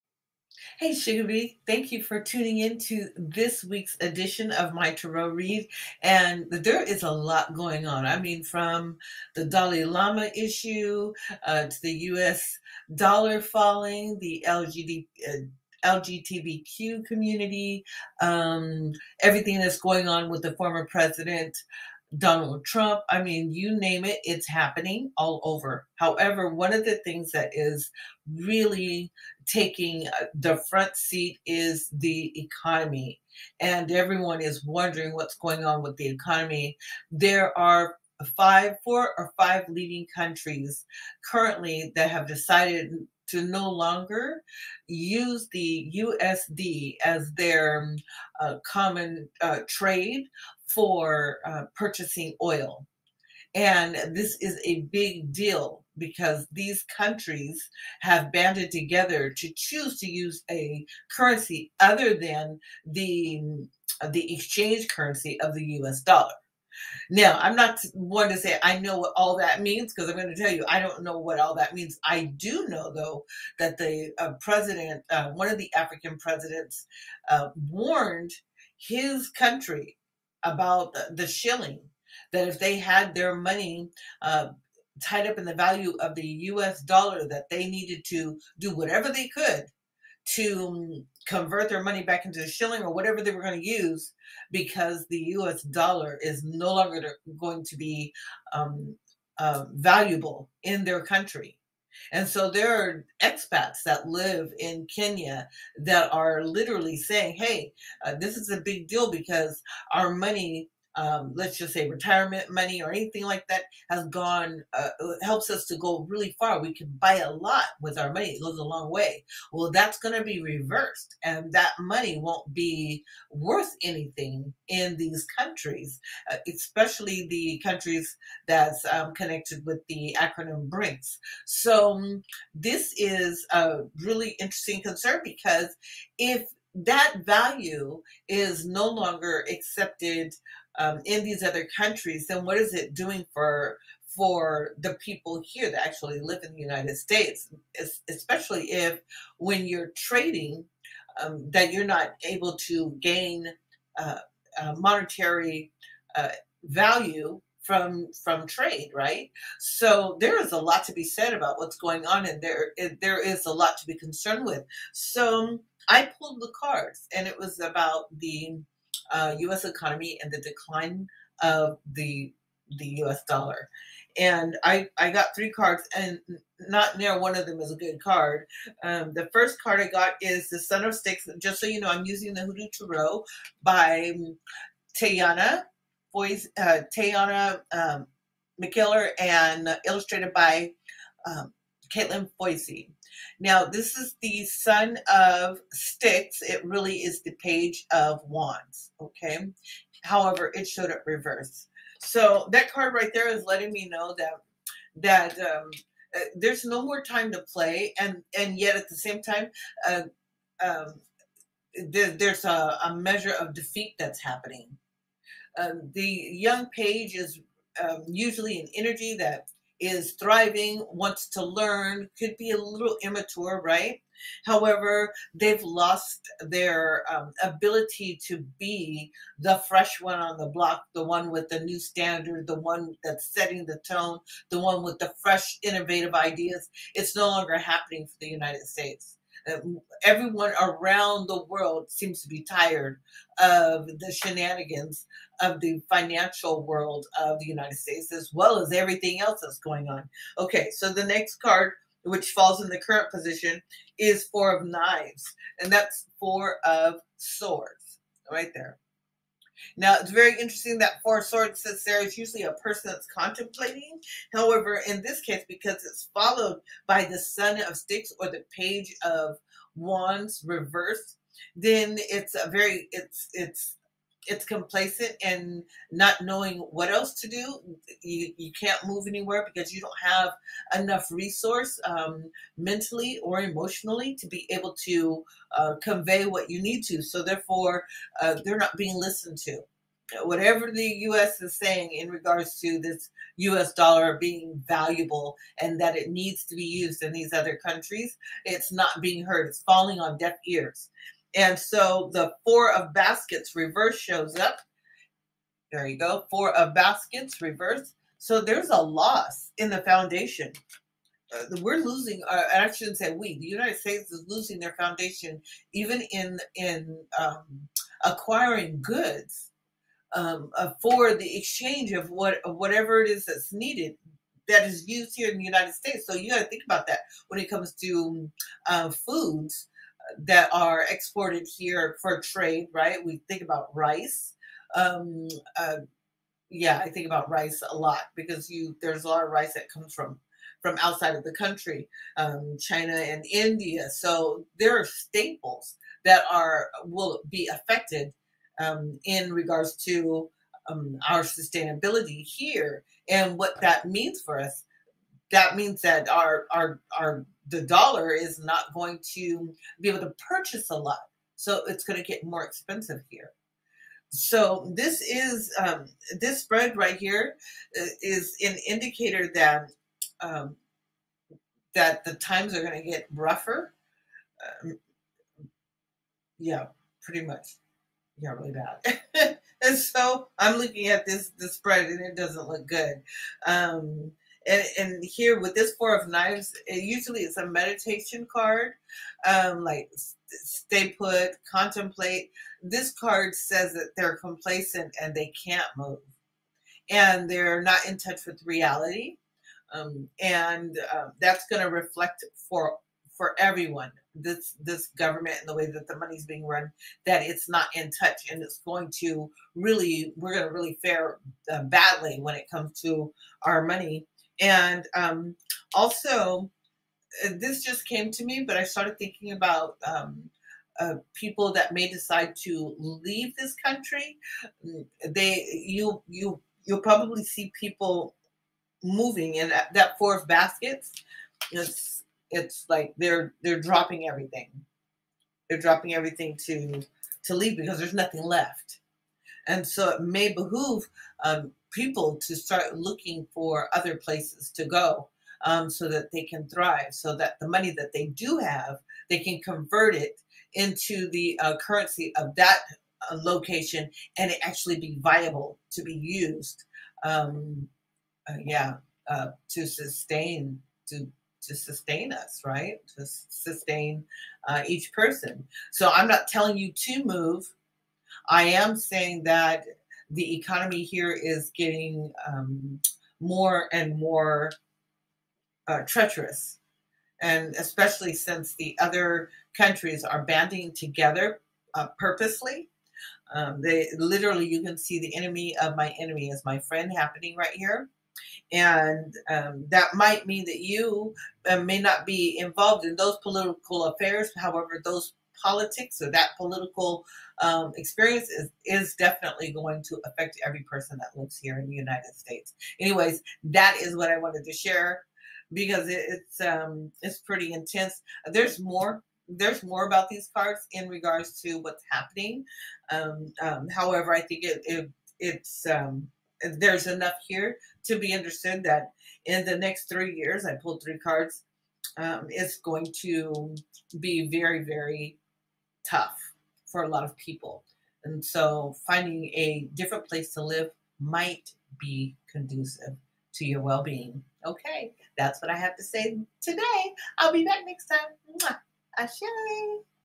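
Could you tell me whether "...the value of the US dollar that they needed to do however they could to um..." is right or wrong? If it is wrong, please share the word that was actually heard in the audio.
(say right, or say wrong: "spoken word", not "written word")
wrong: "whatever", not "however".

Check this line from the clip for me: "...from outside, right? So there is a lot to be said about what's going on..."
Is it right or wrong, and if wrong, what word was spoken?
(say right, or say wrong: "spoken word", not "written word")
wrong: "trade", not "outside".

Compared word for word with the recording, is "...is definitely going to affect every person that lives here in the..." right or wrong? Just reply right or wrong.
right.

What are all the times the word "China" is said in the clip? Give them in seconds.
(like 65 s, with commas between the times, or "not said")
342 s.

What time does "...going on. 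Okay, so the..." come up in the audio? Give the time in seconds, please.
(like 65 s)
249 s.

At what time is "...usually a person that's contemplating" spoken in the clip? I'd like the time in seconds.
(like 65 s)
262 s.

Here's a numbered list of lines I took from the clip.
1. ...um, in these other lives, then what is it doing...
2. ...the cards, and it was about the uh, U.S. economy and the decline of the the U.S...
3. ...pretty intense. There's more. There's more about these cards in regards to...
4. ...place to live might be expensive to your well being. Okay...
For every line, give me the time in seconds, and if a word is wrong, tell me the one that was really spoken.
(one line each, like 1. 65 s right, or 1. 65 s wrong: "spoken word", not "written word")
1. 140 s wrong: "countries", not "lives"
2. 166 s right
3. 507 s right
4. 530 s wrong: "conducive", not "expensive".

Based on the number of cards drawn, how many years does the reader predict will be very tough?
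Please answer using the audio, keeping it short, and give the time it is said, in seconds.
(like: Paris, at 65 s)
3, at 519 s.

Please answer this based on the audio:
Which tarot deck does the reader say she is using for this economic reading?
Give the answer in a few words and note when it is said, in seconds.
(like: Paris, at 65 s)
Hoodoo Tarot, at 182 s.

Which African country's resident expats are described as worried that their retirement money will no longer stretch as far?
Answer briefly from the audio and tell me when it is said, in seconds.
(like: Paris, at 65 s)
Kenya, at 104 s.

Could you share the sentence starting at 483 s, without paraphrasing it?
Um, they literally, you can see the enemy of my enemy is my friend happening right here.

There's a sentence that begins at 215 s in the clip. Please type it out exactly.
Um, the young page is um, usually an energy that is thriving, wants to learn, could be a little immature, right?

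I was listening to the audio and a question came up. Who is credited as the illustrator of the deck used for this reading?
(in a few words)
Katelan Foisy.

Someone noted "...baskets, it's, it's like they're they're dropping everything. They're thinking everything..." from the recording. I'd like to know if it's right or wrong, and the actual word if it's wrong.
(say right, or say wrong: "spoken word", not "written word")
wrong: "dropping", not "thinking".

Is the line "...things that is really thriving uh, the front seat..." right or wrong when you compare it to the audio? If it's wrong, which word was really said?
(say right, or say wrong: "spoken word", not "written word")
wrong: "taking", not "thriving".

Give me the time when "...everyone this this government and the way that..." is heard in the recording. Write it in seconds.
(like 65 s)
403 s.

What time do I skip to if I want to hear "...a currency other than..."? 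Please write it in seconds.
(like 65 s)
60 s.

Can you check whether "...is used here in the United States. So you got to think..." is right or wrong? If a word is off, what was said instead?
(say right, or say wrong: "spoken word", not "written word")
right.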